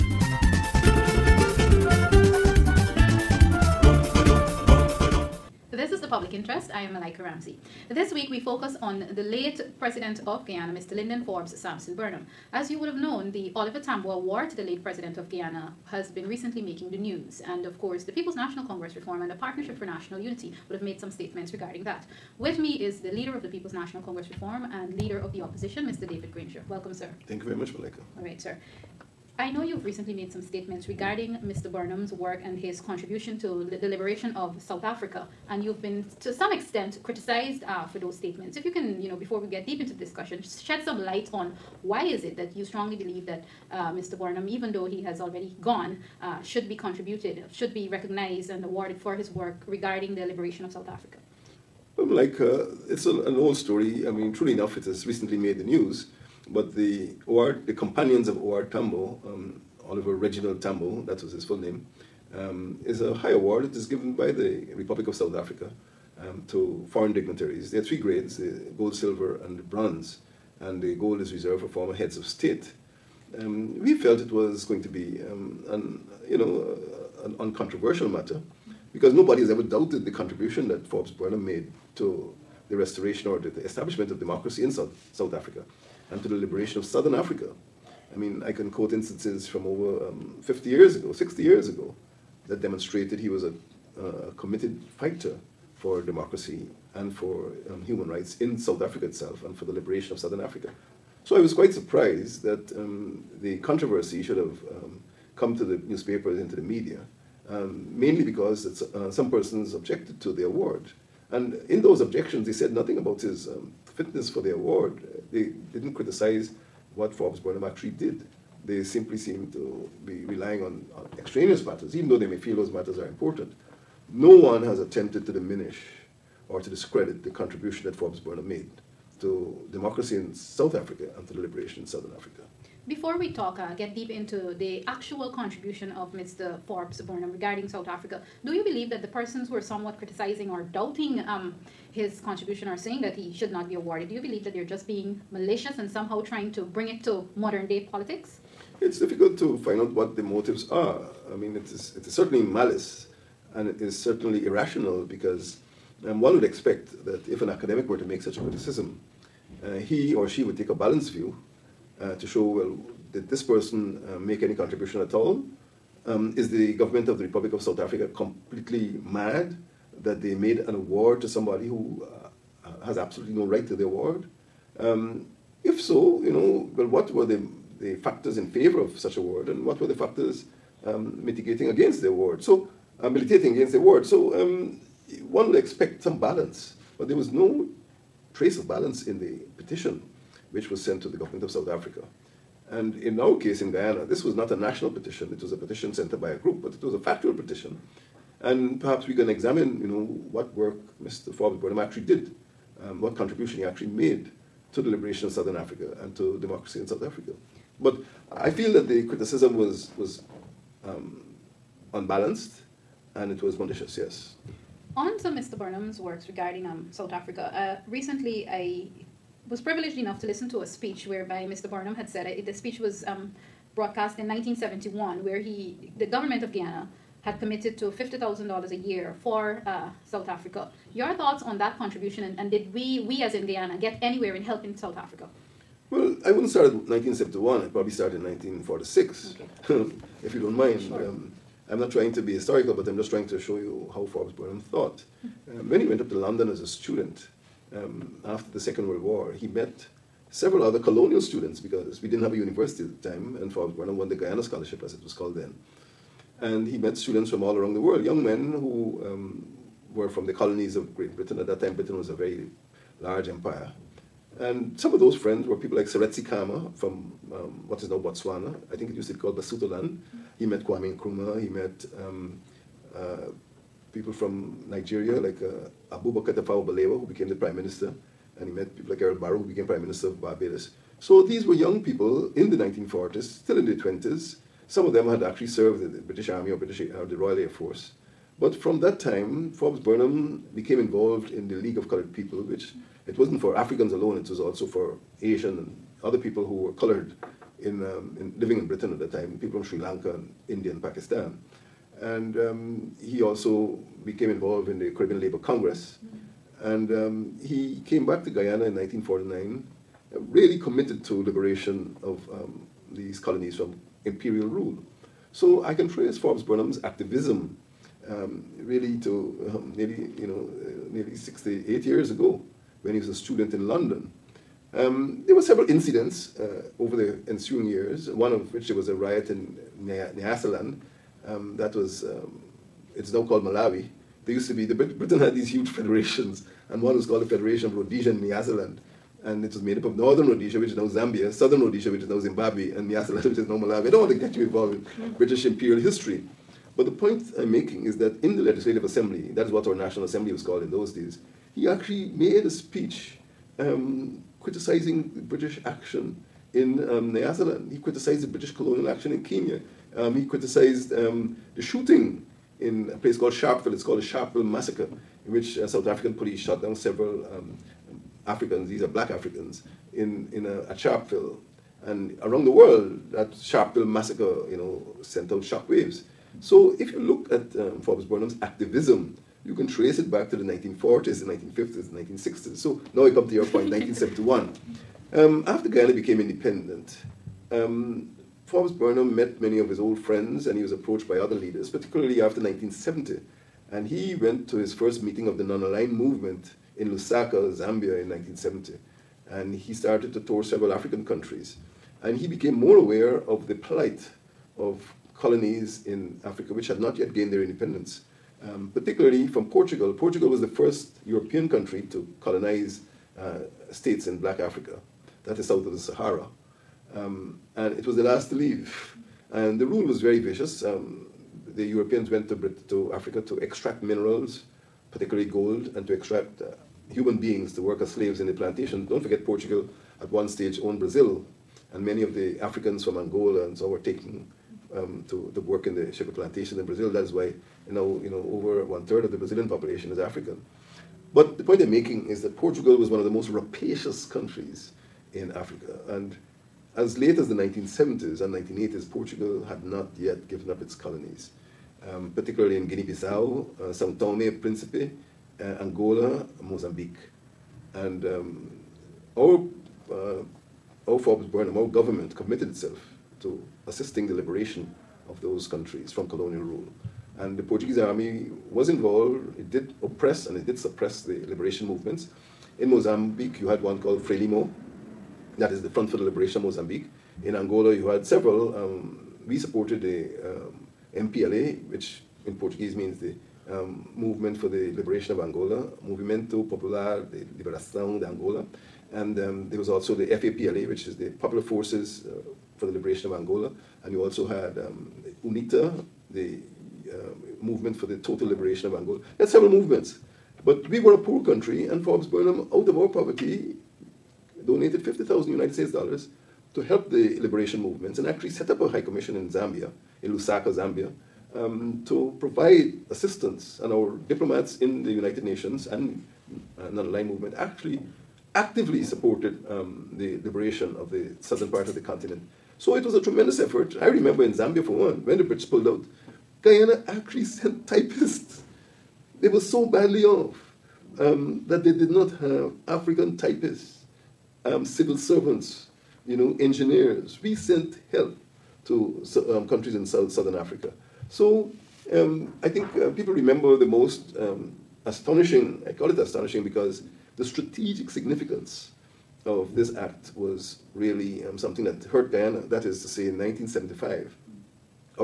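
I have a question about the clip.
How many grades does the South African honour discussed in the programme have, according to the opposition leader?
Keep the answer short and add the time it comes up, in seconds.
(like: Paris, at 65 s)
3, at 67 s.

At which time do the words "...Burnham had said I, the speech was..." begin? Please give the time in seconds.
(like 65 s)
221 s.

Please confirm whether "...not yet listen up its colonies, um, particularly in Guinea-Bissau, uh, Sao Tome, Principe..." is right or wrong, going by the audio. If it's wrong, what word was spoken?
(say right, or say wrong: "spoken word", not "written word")
wrong: "given", not "listen".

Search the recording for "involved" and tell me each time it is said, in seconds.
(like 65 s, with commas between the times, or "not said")
290 s, 304 s, 344 s, 468 s.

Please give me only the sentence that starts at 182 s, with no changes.
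So, uh, militating against the award.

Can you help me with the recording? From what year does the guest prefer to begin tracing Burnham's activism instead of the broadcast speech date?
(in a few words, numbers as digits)
1946.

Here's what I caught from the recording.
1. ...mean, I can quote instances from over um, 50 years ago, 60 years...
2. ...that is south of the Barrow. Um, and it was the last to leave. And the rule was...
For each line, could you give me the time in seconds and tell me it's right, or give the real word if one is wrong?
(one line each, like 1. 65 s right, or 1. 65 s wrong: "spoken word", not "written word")
1. 88 s right
2. 415 s wrong: "Sahara", not "Barrow".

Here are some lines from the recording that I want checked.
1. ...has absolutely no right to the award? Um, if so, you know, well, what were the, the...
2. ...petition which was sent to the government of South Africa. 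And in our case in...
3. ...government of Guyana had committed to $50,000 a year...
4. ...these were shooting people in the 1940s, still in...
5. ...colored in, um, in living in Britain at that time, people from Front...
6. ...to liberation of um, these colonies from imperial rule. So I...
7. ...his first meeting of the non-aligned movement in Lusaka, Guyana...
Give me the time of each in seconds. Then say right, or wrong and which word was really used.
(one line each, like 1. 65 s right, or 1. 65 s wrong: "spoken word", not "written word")
1. 172 s right
2. 189 s right
3. 226 s right
4. 281 s wrong: "young", not "shooting"
5. 296 s wrong: "Sri", not "Front"
6. 311 s right
7. 394 s wrong: "Zambia", not "Guyana".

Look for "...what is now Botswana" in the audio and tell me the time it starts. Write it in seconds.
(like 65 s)
267 s.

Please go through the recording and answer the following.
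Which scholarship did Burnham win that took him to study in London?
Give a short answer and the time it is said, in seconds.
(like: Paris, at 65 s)
Guyana Scholarship, at 254 s.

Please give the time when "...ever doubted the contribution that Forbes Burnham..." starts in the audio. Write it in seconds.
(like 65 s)
79 s.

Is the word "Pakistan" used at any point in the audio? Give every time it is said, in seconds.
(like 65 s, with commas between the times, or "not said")
300 s.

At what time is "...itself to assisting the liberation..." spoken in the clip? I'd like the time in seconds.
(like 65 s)
462 s.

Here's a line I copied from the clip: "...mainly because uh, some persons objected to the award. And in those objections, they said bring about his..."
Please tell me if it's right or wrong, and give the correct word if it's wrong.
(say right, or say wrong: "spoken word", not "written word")
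wrong: "nothing", not "bring".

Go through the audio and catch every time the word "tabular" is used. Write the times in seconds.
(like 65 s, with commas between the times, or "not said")
not said.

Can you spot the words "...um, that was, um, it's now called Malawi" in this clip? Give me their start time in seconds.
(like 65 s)
331 s.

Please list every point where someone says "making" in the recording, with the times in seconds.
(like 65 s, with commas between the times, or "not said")
16 s, 347 s, 441 s.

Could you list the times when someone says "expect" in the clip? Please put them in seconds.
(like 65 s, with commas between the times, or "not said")
156 s, 185 s.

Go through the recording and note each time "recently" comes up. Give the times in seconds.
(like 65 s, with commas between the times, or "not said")
16 s, 29 s, 55 s, 217 s.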